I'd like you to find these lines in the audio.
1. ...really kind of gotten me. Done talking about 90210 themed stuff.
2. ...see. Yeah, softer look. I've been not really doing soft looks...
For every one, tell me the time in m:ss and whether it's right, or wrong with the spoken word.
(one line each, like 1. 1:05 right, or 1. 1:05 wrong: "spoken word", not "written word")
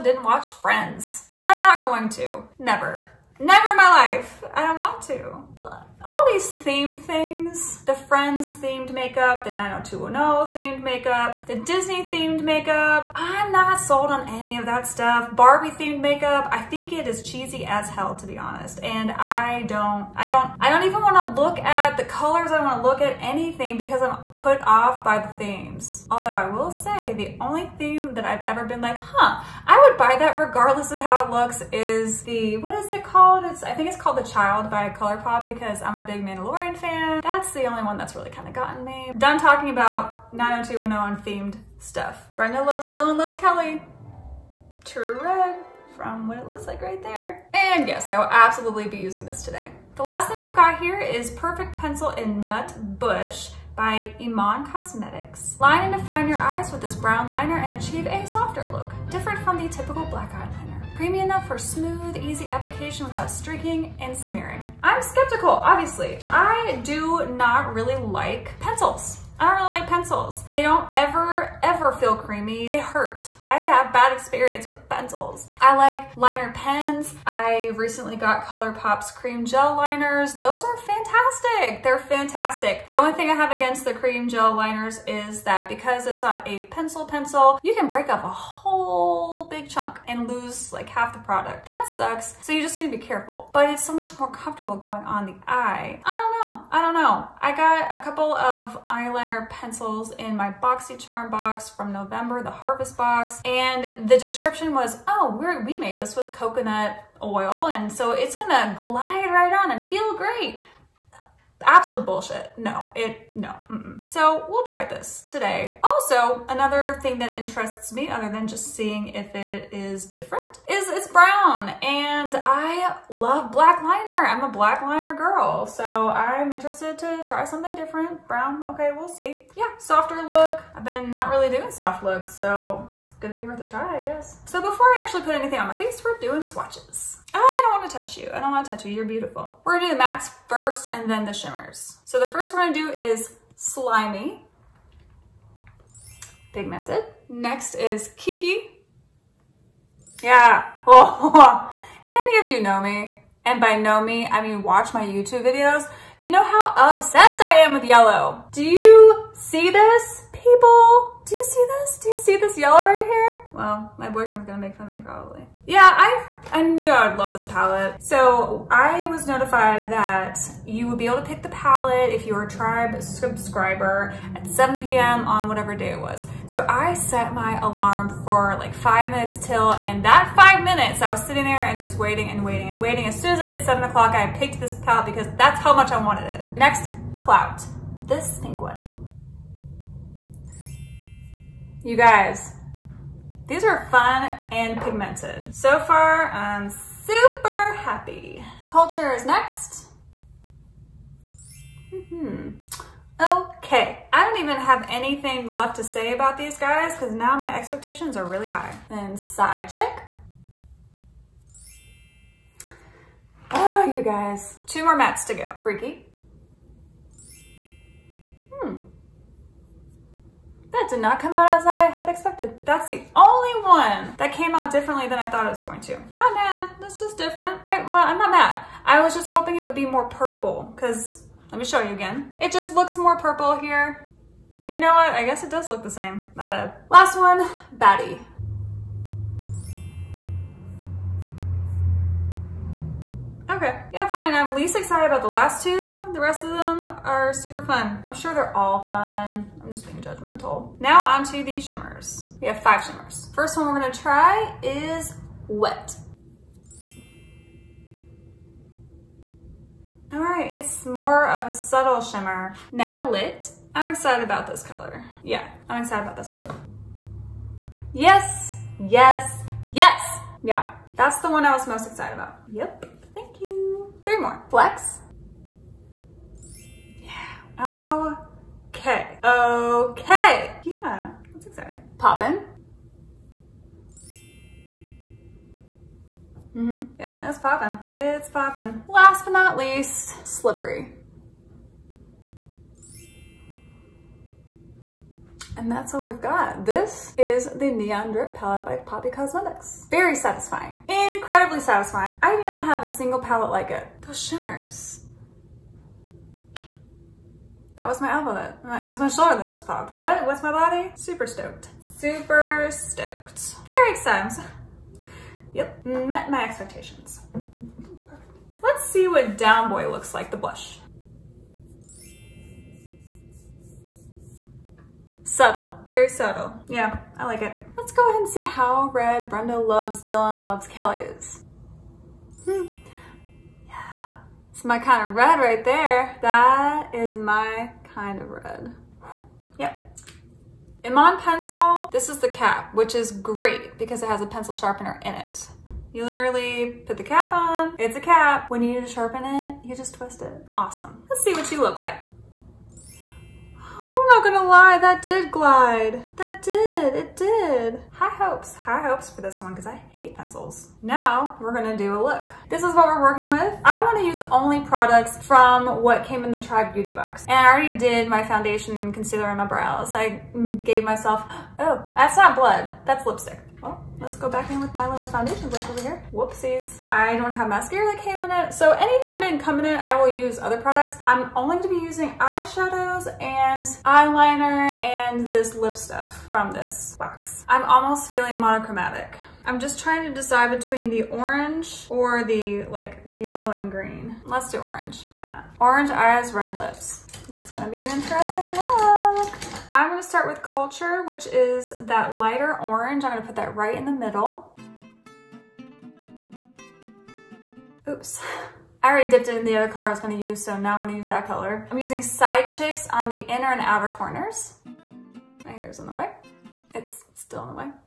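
1. 0:38 right
2. 2:09 right.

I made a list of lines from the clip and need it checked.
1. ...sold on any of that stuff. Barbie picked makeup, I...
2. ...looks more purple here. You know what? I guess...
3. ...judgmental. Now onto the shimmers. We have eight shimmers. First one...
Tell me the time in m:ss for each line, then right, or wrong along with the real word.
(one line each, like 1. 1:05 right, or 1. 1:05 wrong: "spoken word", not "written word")
1. 0:13 wrong: "themed", not "picked"
2. 3:52 right
3. 4:10 wrong: "five", not "eight".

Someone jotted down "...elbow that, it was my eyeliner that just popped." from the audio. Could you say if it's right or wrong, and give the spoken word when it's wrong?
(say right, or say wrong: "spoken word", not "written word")
wrong: "shoulder", not "eyeliner".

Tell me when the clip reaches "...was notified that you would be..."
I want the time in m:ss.
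2:49.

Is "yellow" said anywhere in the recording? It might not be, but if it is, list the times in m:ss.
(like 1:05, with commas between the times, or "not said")
2:37, 2:42, 6:33.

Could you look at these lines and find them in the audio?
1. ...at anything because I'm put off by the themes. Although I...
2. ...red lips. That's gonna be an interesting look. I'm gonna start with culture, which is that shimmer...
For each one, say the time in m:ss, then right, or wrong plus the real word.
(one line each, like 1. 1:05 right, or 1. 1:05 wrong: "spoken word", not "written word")
1. 0:23 right
2. 6:36 wrong: "lighter", not "shimmer".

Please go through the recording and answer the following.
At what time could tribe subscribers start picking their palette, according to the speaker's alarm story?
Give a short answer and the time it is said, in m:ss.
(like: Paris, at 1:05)
7 p.m., at 2:54.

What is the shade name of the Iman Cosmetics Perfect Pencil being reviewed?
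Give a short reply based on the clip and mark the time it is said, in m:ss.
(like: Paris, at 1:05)
Nut Bush, at 0:52.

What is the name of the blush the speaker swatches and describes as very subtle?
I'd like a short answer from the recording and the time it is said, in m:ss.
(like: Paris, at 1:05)
Down Boy, at 5:19.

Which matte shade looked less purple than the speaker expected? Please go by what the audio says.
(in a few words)
Freaky.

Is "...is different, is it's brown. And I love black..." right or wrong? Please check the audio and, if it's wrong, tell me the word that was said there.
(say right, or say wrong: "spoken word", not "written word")
right.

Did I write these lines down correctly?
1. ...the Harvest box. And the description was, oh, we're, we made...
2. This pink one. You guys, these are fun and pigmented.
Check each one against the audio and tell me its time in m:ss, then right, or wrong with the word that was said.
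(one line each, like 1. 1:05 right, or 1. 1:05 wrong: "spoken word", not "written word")
1. 1:42 right
2. 3:08 right.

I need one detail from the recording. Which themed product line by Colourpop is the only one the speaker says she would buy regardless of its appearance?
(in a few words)
The Child.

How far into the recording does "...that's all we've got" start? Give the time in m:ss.
4:55.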